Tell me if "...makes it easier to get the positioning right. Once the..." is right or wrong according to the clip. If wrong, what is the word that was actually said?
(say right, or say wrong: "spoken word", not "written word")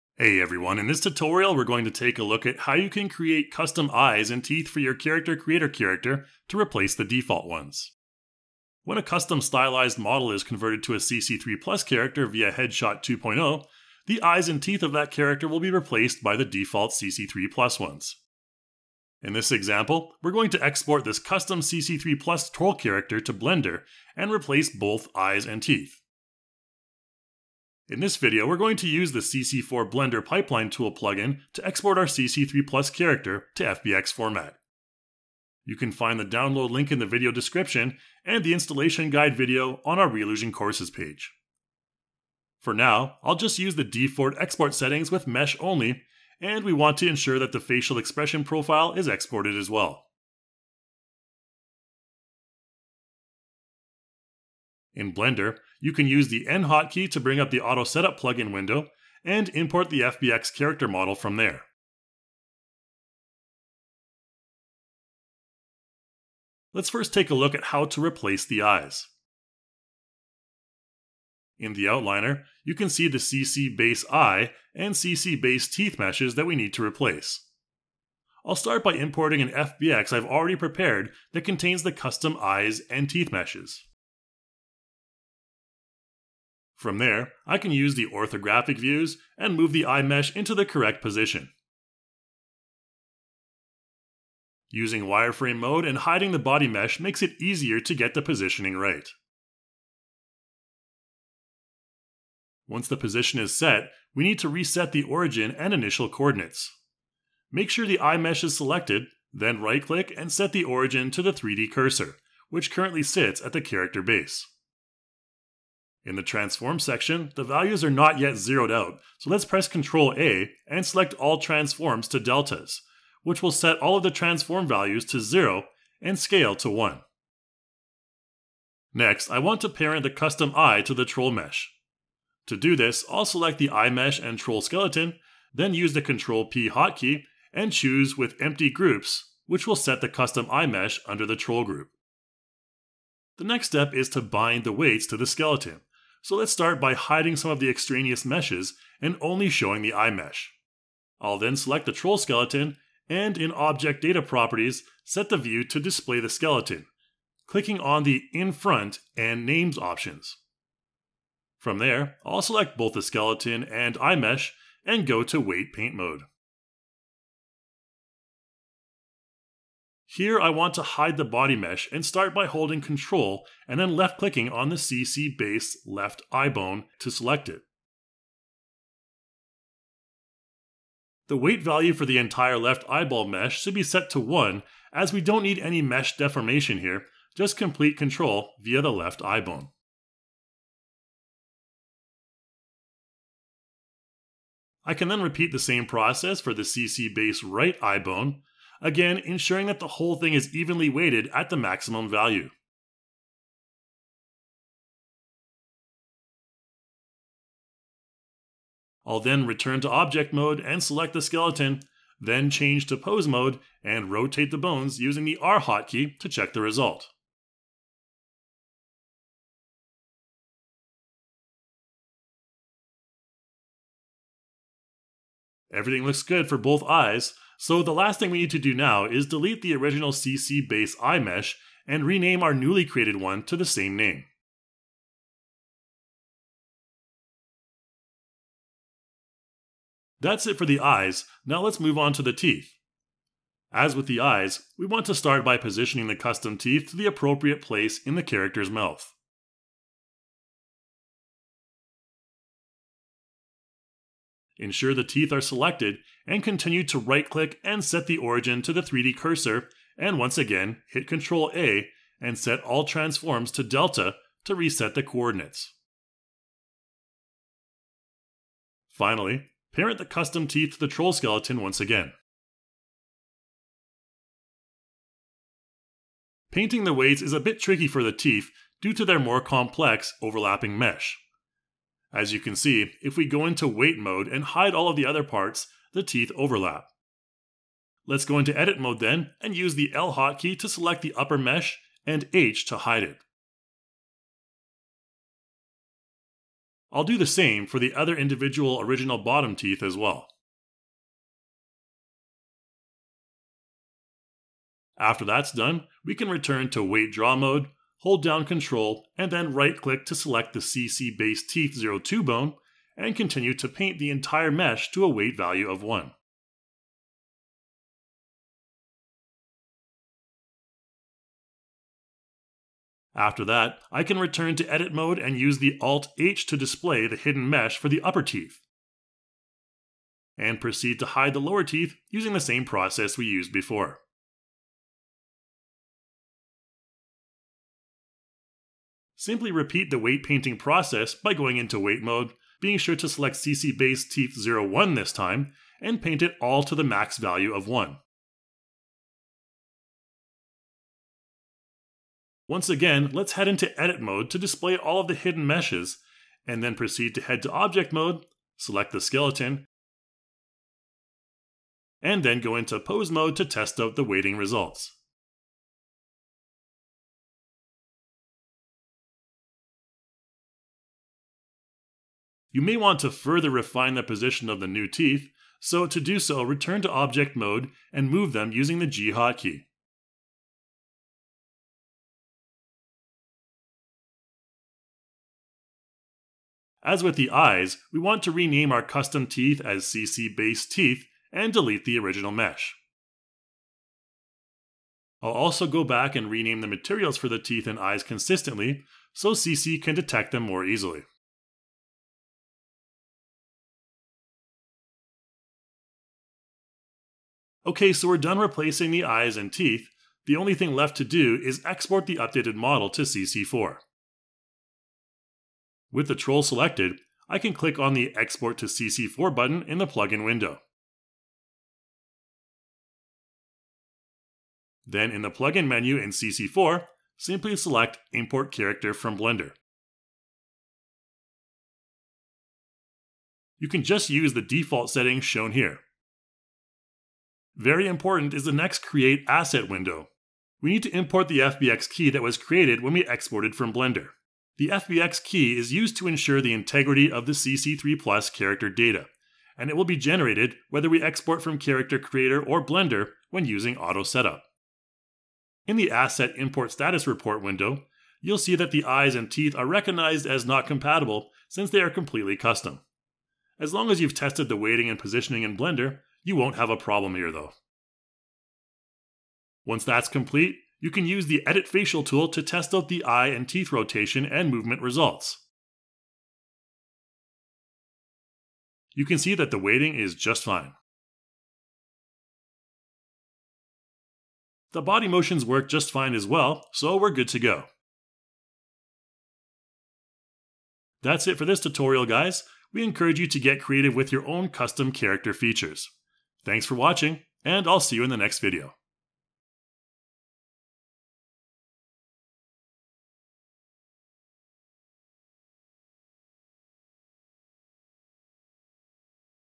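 right.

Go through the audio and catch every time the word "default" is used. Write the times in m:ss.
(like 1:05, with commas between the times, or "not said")
0:07, 0:16, 0:43, 7:14.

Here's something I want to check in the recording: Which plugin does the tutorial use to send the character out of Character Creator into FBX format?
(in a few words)
CC4 Blender Pipeline.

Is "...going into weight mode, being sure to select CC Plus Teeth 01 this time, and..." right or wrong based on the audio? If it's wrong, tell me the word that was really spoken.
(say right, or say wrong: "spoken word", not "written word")
wrong: "Base", not "Plus".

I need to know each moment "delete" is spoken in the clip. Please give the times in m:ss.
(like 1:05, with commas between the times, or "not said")
3:49, 6:31.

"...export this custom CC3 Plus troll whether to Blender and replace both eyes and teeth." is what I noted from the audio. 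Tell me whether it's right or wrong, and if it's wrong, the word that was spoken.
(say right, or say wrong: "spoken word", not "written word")
wrong: "character", not "whether".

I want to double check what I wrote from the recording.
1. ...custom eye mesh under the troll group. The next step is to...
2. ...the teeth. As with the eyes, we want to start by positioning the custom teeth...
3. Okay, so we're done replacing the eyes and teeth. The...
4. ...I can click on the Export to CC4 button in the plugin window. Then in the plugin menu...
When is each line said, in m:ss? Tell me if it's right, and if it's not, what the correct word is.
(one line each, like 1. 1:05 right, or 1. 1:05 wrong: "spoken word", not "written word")
1. 2:20 right
2. 4:02 right
3. 6:47 right
4. 6:57 right.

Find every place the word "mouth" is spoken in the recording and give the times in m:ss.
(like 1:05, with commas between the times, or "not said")
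4:08.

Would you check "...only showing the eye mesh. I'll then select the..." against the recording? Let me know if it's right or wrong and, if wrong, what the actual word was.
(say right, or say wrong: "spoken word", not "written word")
right.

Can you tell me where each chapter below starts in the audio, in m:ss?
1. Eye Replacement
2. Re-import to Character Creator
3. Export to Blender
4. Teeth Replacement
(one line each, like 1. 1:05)
1. 1:18
2. 6:49
3. 0:28
4. 4:00.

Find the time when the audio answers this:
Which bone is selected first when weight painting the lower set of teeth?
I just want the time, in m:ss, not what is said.
5:10.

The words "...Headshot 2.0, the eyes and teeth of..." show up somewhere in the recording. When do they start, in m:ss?
0:12.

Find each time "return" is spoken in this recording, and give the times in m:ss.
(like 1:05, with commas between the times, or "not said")
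3:29, 5:06, 5:24, 6:16.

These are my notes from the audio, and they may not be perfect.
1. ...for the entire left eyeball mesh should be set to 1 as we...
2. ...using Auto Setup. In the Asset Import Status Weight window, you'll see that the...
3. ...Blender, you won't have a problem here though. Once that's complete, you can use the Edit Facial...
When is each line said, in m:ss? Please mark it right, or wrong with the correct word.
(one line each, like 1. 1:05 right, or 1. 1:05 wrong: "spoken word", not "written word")
1. 3:01 right
2. 7:33 wrong: "Report", not "Weight"
3. 7:45 right.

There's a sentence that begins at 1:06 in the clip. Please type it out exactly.
Let's first take a look at how to replace the eyes.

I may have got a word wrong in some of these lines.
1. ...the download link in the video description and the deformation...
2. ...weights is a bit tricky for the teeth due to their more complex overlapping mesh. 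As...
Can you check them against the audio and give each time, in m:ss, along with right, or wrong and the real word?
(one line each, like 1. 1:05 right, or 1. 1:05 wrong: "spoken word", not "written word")
1. 0:36 wrong: "installation", not "deformation"
2. 4:36 right.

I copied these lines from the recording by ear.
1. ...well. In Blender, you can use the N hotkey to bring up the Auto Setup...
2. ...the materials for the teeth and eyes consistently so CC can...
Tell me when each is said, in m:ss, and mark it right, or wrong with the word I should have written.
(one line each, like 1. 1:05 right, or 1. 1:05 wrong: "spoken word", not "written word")
1. 0:49 right
2. 6:36 right.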